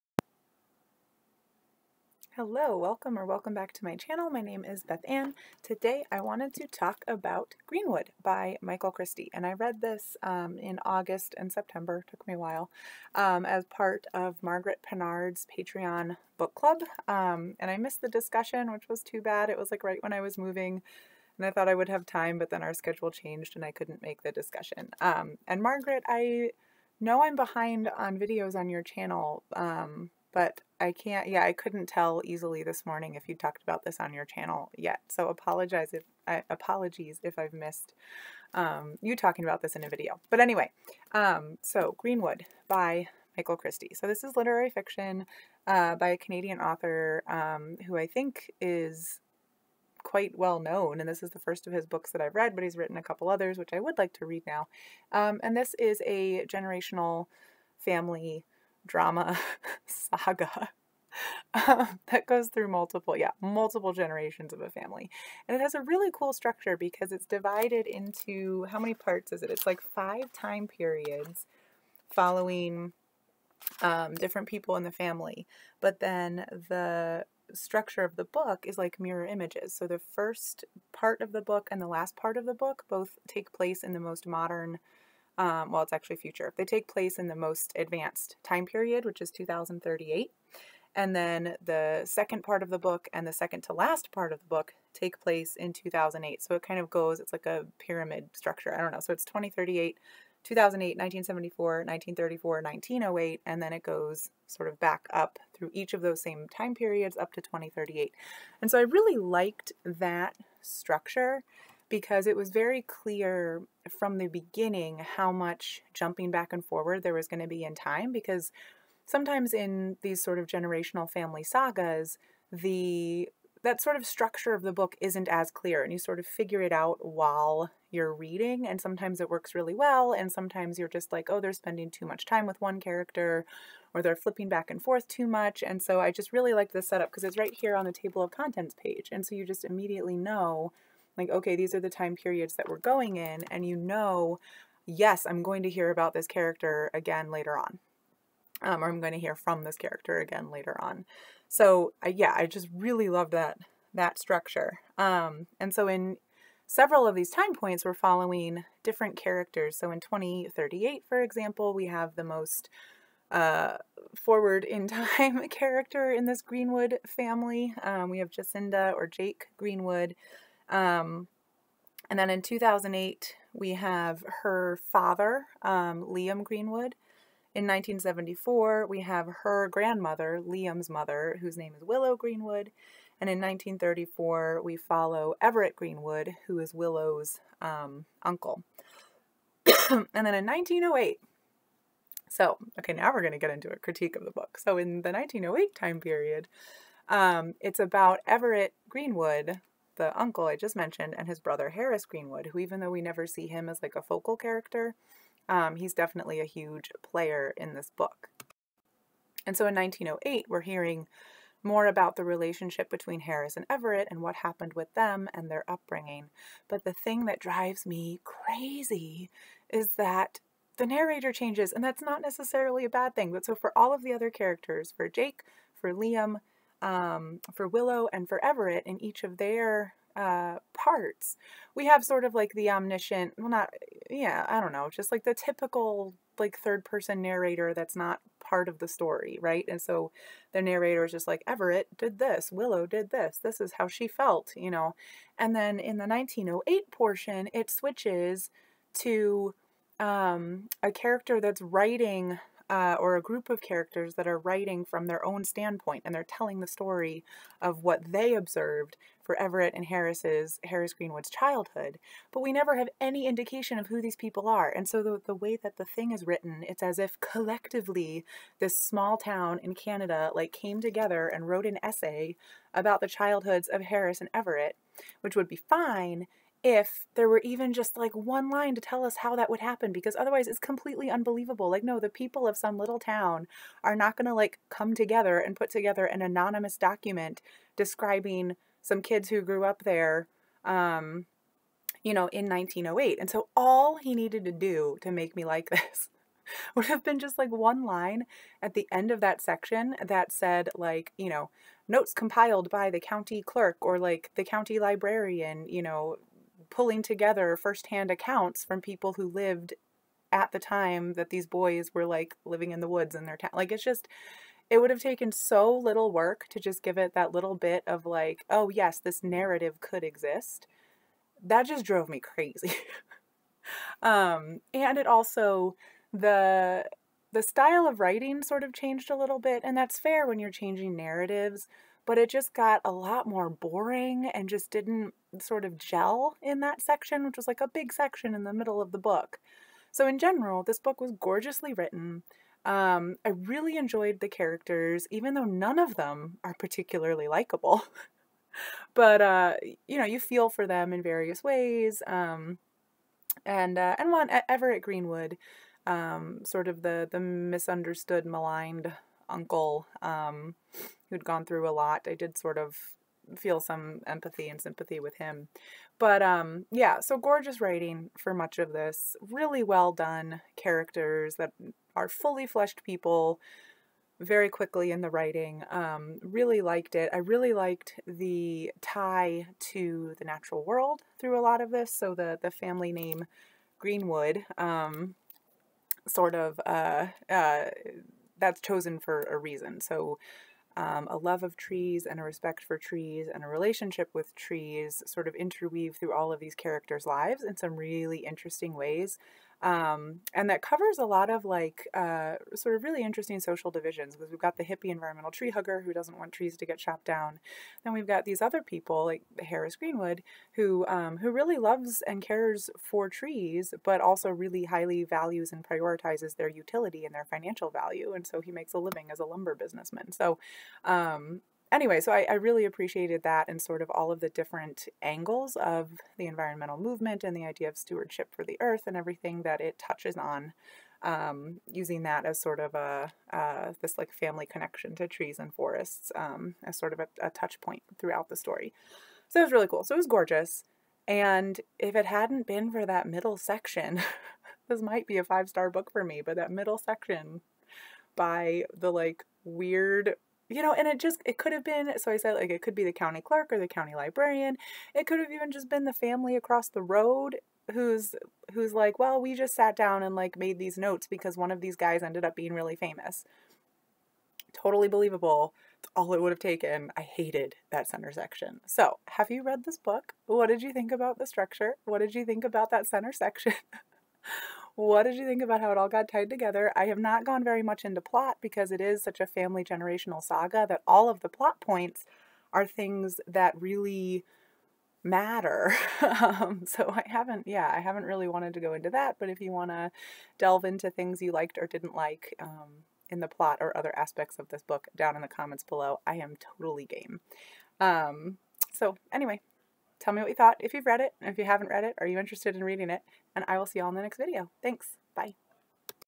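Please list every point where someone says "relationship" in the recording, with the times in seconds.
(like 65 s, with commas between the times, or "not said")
212 s, 393 s.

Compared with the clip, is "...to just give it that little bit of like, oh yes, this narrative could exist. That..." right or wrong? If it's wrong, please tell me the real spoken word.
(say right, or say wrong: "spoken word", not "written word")
right.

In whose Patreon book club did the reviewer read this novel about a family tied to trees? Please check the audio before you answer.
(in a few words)
Margaret Pinard.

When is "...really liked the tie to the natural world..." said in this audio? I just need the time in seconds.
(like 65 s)
377 s.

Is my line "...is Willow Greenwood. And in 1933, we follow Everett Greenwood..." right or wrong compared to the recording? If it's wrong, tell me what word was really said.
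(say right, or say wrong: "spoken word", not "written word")
wrong: "1934", not "1933".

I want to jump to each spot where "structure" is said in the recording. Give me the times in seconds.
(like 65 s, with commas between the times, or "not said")
66 s, 77 s, 98 s, 110 s, 124 s, 154 s, 471 s.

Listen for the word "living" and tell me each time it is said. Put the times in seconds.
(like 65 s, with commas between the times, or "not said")
312 s, 418 s.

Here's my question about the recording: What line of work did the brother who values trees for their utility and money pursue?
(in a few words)
lumber businessman.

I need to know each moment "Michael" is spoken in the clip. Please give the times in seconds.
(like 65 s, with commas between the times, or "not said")
8 s, 43 s.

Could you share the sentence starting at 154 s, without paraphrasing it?
Um, and so in several of these time points, we're following different characters.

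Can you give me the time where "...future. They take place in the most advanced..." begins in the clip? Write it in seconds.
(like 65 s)
86 s.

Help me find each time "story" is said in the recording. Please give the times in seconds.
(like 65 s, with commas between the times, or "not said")
238 s, 256 s, 438 s.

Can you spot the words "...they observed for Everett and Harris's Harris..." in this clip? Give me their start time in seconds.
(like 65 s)
258 s.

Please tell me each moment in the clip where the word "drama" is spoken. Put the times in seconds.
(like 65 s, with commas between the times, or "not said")
58 s.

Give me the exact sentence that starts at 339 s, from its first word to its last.
So, in general, this book was gorgeously written.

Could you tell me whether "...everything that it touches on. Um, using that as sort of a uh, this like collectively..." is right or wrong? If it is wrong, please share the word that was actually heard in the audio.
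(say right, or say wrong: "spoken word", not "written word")
wrong: "family", not "collectively".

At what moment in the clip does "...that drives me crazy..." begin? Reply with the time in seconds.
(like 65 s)
217 s.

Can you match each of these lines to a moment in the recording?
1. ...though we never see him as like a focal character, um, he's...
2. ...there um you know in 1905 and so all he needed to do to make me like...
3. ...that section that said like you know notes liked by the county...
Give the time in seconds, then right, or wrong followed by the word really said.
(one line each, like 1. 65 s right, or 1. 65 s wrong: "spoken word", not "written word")
1. 202 s right
2. 289 s wrong: "1908", not "1905"
3. 299 s wrong: "compiled", not "liked".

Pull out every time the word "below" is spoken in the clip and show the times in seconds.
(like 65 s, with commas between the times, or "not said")
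495 s.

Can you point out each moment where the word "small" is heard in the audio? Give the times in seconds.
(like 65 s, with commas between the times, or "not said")
268 s.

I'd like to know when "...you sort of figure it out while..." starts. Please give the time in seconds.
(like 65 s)
125 s.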